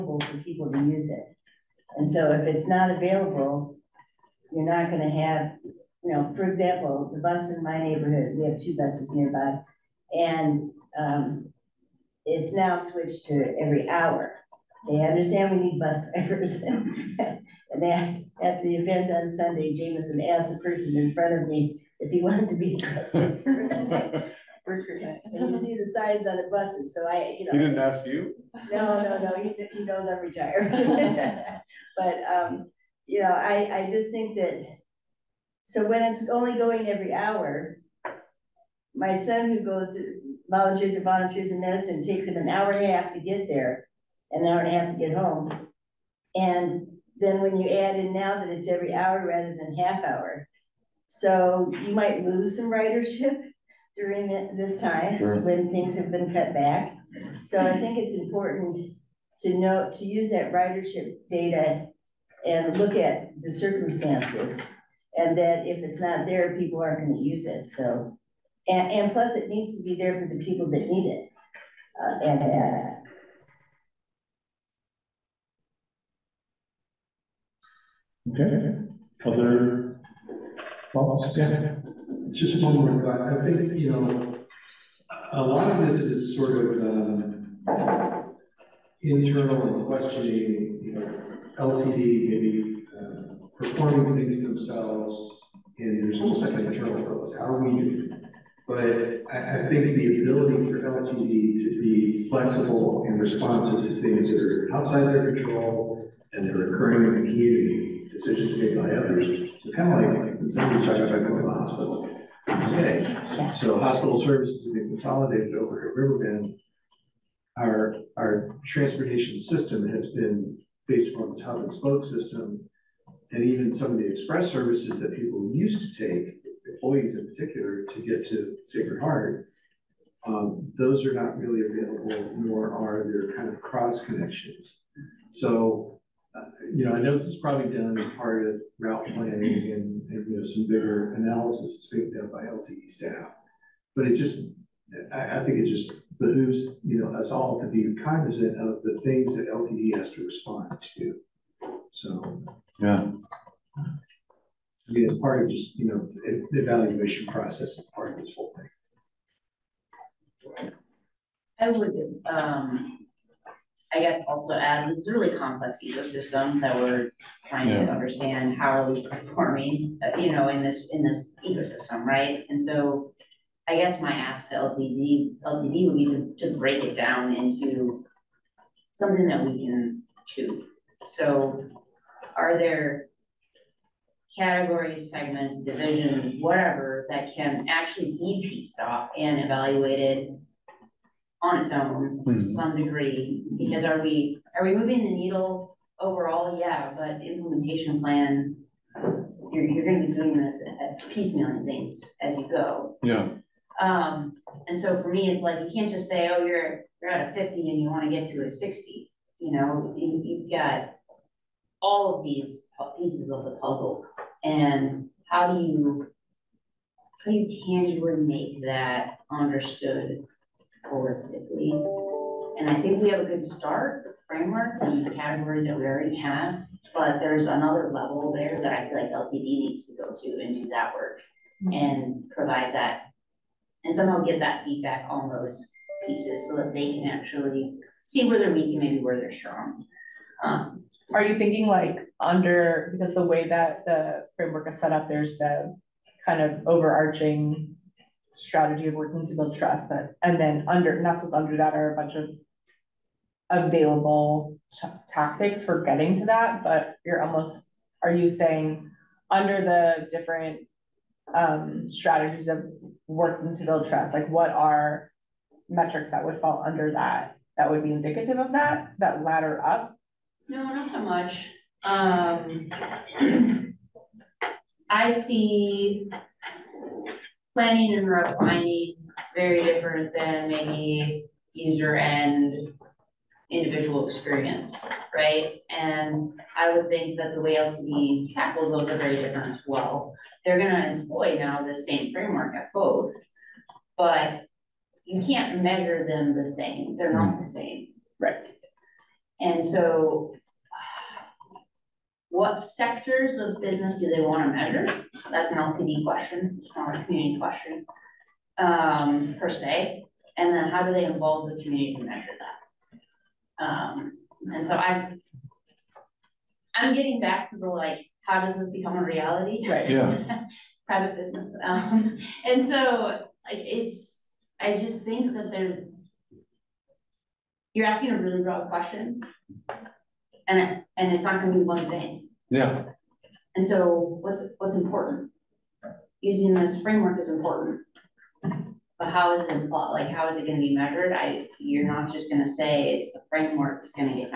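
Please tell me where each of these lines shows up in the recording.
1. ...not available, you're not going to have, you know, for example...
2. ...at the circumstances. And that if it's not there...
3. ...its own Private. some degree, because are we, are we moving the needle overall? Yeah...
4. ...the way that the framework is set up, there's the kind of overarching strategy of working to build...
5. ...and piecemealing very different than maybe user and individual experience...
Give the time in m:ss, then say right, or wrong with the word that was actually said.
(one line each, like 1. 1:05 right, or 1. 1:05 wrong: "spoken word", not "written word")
1. 0:02 right
2. 1:02 right
3. 3:11 wrong: "Mhm", not "Private"
4. 4:03 right
5. 4:37 wrong: "refining", not "piecemealing".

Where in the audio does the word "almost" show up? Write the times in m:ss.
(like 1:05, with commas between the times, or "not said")
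1:36, 4:17.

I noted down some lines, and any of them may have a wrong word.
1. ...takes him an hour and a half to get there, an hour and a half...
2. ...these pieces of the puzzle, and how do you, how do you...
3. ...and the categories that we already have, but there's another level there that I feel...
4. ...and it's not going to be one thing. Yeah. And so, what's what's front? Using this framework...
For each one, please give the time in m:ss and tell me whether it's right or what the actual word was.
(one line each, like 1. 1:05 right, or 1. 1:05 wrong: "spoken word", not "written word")
1. 0:42 right
2. 3:32 right
3. 3:44 right
4. 5:30 wrong: "important", not "front".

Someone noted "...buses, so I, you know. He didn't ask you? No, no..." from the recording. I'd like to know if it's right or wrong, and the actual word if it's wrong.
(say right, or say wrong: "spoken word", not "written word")
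right.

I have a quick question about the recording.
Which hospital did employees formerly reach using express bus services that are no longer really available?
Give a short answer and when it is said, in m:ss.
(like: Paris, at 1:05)
Sacred Heart, at 2:08.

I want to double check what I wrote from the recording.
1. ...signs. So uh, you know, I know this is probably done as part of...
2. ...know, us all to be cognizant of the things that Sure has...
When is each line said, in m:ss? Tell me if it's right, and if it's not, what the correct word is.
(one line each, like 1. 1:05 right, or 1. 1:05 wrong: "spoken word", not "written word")
1. 2:14 wrong: "connections", not "signs"
2. 2:27 wrong: "LTD", not "Sure".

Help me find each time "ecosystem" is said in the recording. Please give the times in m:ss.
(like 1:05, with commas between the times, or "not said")
2:45, 2:51.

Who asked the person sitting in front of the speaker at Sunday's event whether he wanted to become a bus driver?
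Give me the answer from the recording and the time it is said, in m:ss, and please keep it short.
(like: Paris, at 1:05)
Jameson, at 0:19.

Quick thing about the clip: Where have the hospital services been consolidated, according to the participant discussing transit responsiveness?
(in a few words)
Riverbend.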